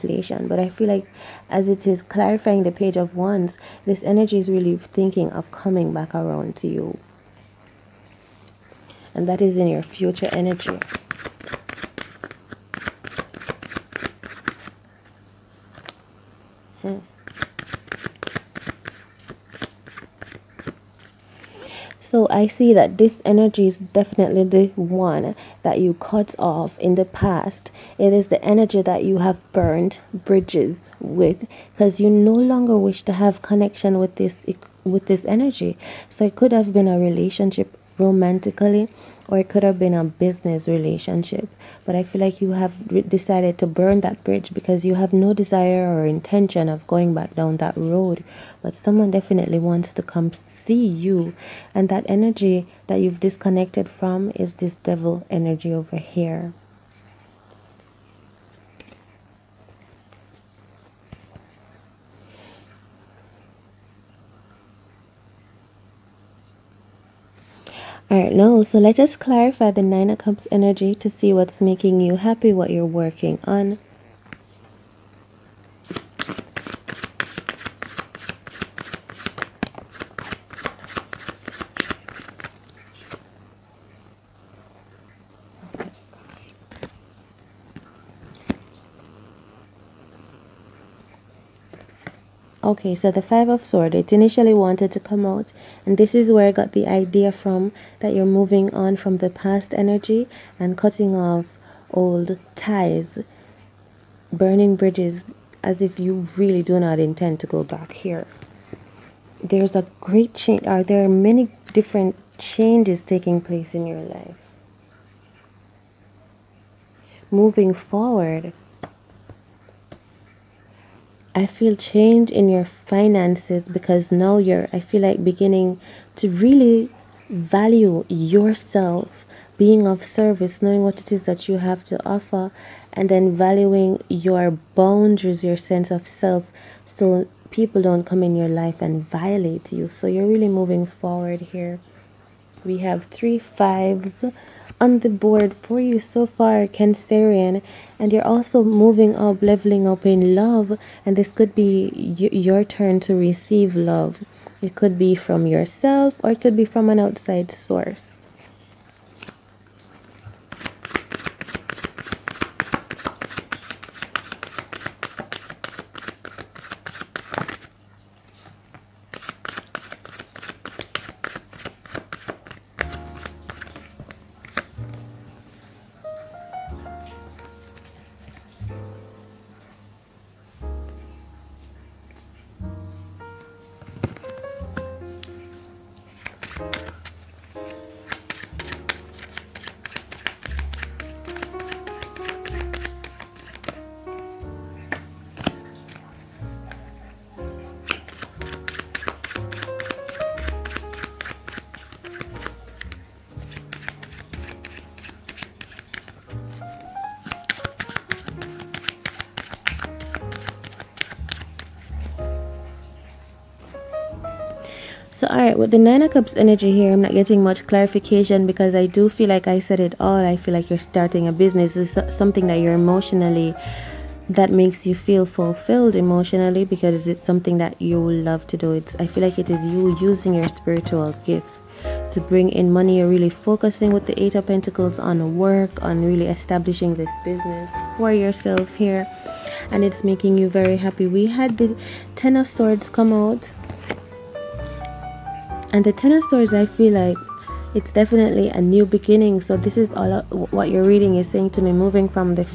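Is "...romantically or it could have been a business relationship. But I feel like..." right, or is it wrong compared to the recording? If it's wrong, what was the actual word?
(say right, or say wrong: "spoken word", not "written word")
right.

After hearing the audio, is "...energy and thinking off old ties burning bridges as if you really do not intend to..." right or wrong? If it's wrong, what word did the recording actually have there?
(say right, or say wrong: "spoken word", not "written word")
wrong: "cutting", not "thinking".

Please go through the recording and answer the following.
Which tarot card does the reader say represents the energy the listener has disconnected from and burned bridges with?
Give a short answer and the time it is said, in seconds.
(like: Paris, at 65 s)
Devil, at 54 s.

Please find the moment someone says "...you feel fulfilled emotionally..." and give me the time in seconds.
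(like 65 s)
224 s.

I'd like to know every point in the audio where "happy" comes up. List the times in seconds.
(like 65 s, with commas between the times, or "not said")
72 s, 240 s.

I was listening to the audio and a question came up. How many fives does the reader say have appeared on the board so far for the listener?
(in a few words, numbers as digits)
3.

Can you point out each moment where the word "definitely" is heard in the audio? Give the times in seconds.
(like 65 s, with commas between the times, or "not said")
23 s, 49 s, 247 s.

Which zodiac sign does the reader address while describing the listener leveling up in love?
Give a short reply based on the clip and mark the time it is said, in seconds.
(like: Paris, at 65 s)
Cancerian, at 146 s.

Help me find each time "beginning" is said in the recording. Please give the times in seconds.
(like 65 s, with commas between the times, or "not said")
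125 s, 248 s.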